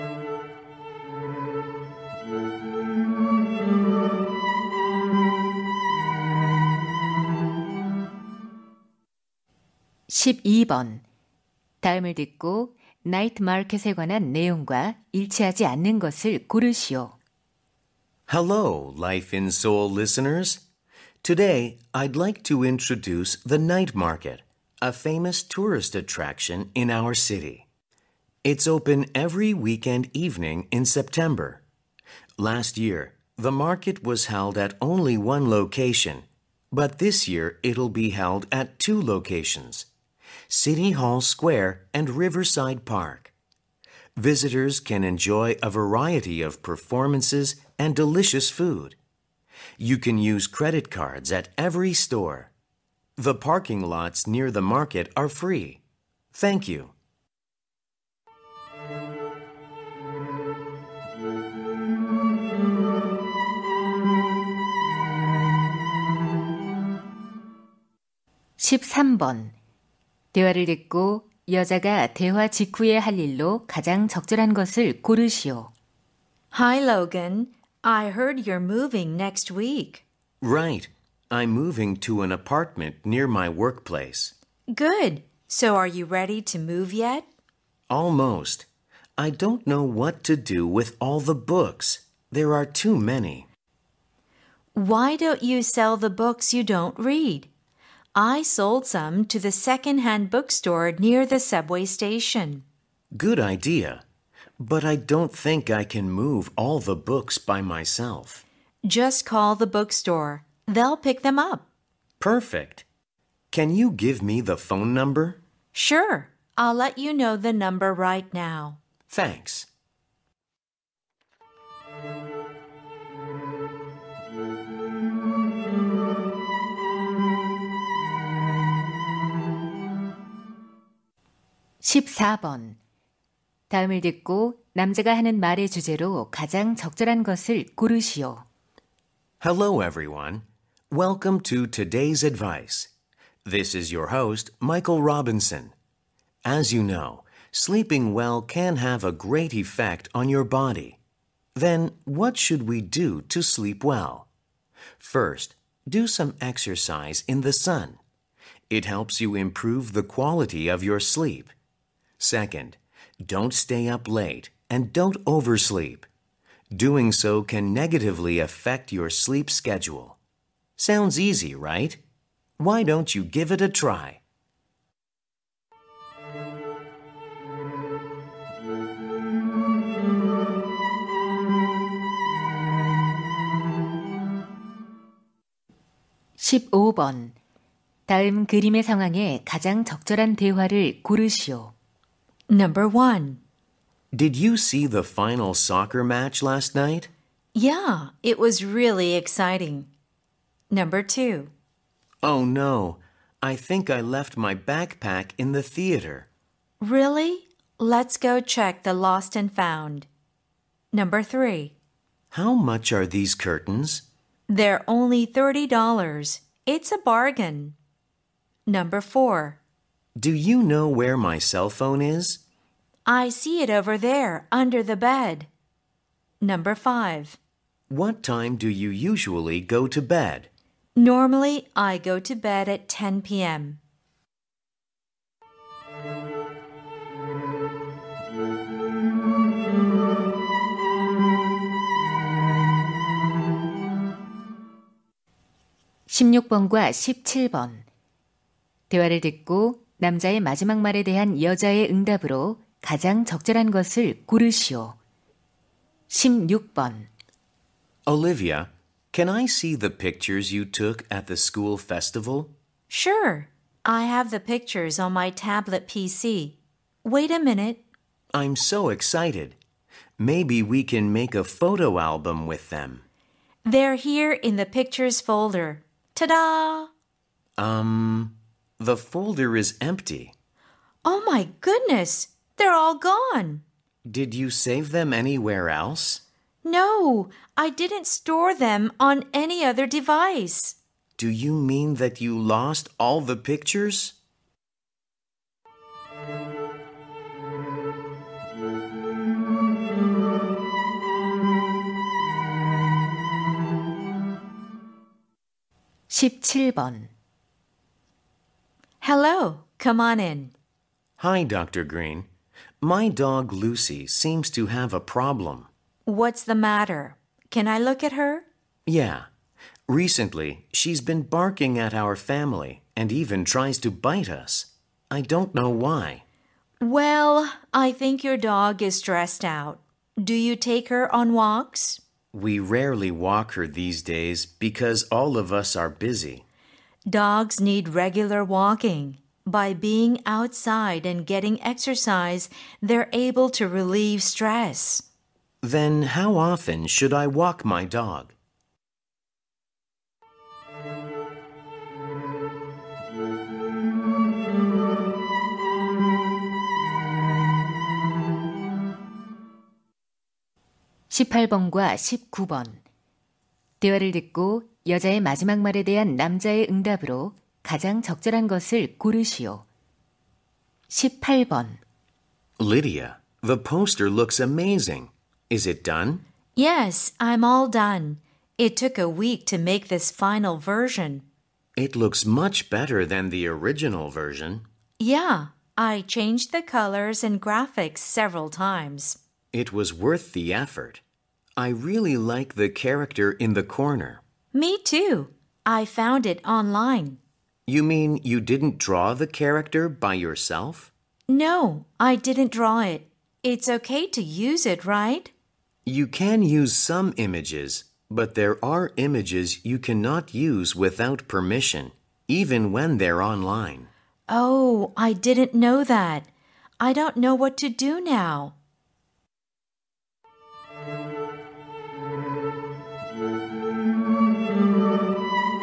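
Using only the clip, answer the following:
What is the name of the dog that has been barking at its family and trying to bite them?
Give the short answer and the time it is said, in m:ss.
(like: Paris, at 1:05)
Lucy, at 5:13.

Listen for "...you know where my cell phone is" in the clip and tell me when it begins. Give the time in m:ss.
3:40.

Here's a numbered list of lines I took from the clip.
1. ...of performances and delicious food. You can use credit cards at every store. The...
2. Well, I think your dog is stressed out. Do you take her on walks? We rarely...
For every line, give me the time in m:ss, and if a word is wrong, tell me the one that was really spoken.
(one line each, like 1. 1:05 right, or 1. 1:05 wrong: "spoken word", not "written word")
1. 0:46 right
2. 5:26 right.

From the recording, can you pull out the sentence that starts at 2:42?
Second, don't stay up late and don't oversleep.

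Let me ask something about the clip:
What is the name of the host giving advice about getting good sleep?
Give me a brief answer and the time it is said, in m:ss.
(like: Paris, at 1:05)
Michael Robinson, at 2:24.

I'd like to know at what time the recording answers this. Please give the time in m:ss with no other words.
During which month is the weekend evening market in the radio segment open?
0:30.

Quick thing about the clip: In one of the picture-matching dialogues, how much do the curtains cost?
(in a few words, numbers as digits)
$30.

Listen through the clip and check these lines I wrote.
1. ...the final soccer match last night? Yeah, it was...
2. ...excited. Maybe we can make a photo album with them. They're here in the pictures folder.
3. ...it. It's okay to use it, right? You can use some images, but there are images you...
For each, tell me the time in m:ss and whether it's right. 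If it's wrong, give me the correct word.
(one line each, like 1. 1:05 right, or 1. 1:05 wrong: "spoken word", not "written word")
1. 3:14 right
2. 4:28 right
3. 6:42 right.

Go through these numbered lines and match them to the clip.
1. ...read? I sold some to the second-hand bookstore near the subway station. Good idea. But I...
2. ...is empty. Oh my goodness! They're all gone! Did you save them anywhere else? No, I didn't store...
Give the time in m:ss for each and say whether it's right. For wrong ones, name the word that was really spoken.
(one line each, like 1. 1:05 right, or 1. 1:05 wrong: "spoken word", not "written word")
1. 1:36 right
2. 4:39 right.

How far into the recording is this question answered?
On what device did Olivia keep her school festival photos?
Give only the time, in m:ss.
4:25.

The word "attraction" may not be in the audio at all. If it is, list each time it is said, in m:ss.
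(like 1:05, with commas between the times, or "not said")
0:25.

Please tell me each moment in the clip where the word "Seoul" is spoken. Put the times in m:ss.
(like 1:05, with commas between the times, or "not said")
0:19.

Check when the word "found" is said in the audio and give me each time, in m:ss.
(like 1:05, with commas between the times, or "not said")
3:29, 6:35.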